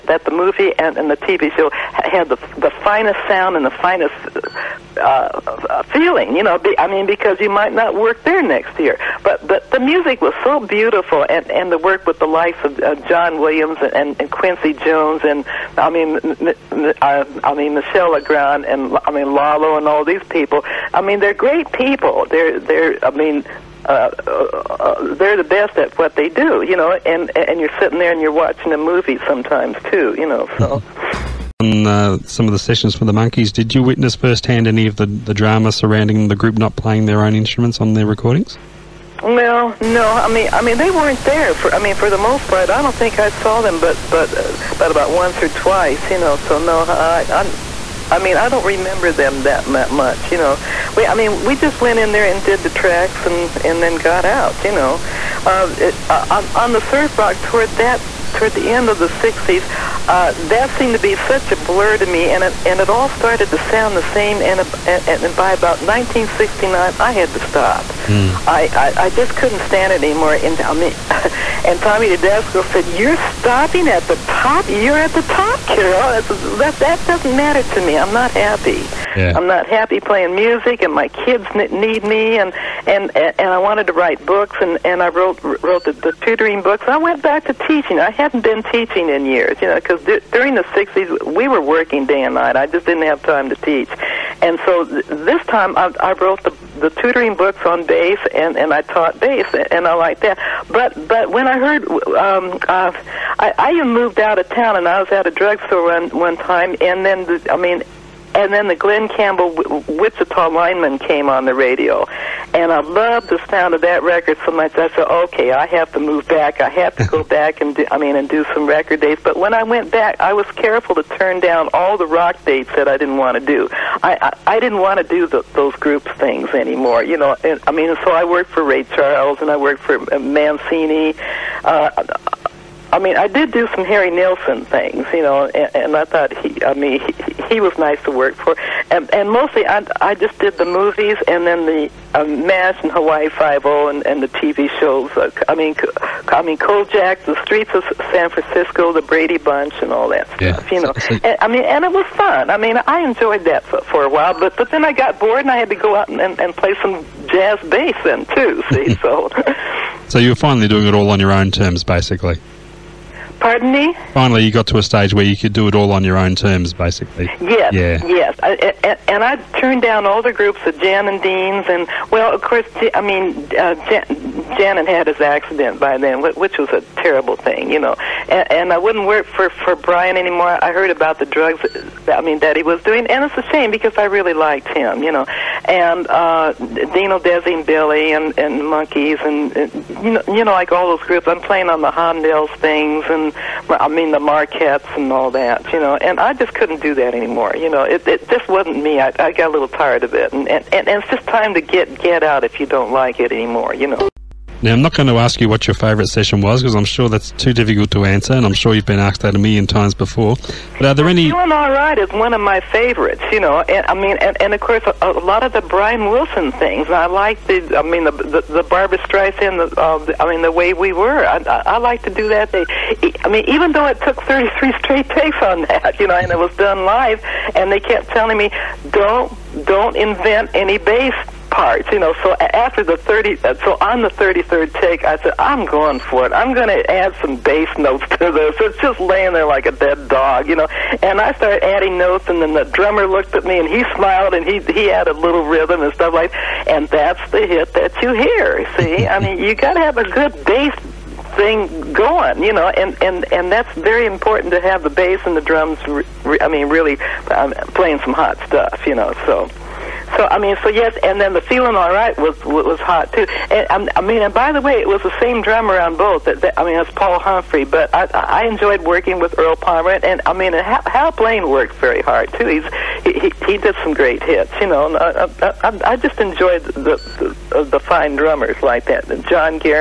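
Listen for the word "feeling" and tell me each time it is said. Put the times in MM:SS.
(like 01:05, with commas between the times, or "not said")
00:05, 04:21.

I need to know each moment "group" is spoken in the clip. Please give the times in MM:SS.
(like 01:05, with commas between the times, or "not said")
00:36, 02:05, 02:50, 03:11.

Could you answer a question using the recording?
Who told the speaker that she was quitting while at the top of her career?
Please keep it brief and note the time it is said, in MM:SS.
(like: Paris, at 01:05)
Tommy Tedesco, at 01:11.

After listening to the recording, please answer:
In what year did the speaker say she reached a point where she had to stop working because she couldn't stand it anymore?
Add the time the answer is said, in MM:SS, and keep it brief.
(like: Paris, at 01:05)
1969, at 01:05.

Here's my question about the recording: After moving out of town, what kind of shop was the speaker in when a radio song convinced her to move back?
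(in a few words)
A drugstore.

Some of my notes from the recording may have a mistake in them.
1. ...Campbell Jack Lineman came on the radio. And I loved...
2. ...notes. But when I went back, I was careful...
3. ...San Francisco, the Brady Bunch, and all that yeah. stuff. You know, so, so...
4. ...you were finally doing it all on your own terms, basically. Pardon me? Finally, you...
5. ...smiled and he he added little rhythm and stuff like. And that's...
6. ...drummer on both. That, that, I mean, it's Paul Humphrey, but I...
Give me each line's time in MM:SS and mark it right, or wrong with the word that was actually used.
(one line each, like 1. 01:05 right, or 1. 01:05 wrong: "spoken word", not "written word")
1. 01:49 wrong: "Wichita", not "Jack"
2. 01:58 wrong: "dates", not "notes"
3. 02:28 right
4. 02:40 right
5. 04:03 right
6. 04:25 right.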